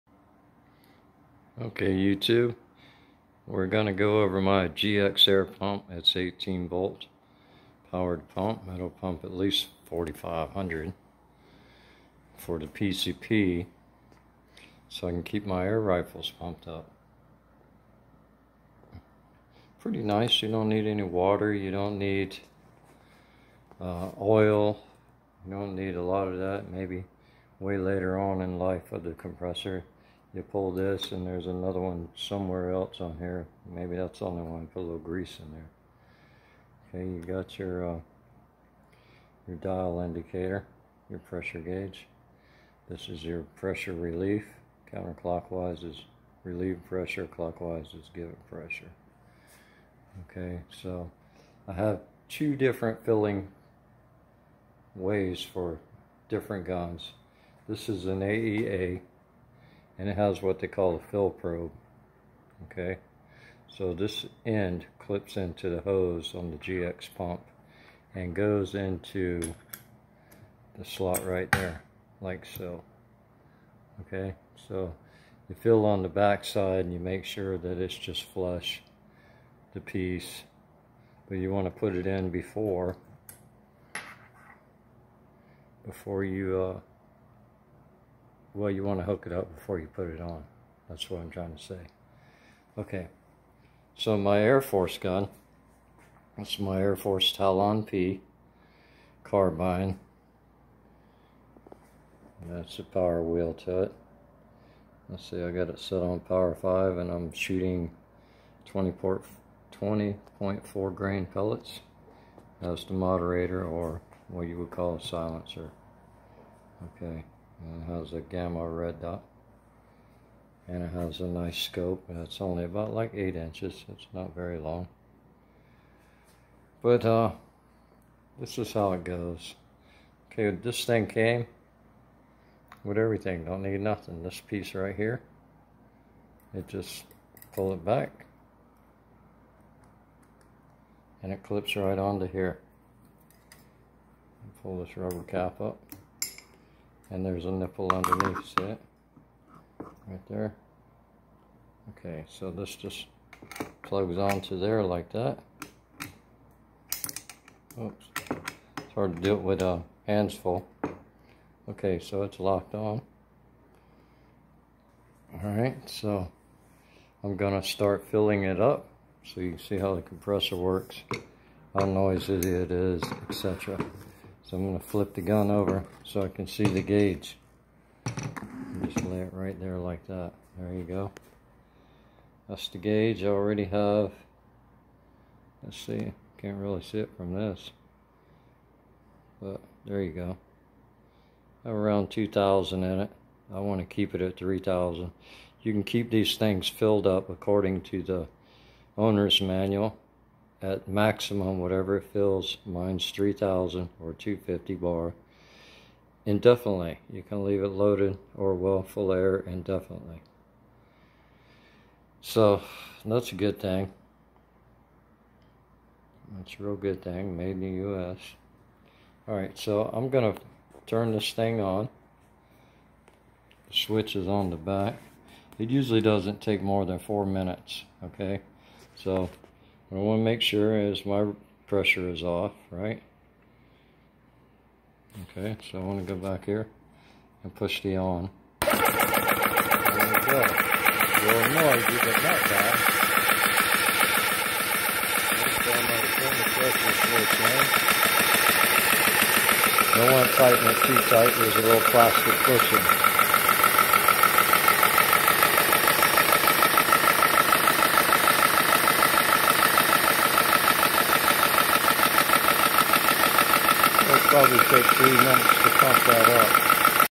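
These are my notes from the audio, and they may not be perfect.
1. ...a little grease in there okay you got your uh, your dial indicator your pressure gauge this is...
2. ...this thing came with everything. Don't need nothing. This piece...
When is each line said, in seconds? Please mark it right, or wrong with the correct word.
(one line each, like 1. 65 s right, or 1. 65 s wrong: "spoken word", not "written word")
1. 34 s right
2. 130 s right.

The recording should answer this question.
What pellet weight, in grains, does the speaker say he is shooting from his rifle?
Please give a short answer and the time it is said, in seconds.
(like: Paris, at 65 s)
20.4 grain, at 108 s.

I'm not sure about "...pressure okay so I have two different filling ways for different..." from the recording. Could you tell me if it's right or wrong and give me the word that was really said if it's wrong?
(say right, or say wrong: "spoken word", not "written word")
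right.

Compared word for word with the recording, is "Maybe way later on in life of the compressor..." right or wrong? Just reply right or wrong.
right.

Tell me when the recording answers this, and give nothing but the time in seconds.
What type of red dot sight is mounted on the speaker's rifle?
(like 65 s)
118 s.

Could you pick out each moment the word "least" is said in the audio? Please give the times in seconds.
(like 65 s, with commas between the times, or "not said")
9 s.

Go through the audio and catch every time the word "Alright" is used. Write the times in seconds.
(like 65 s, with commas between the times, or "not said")
165 s, 219 s.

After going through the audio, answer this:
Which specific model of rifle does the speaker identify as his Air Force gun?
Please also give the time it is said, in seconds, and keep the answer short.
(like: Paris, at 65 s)
Talon P carbine, at 97 s.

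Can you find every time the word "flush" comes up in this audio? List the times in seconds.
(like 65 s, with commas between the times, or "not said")
78 s.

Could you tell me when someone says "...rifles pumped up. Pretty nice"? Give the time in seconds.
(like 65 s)
15 s.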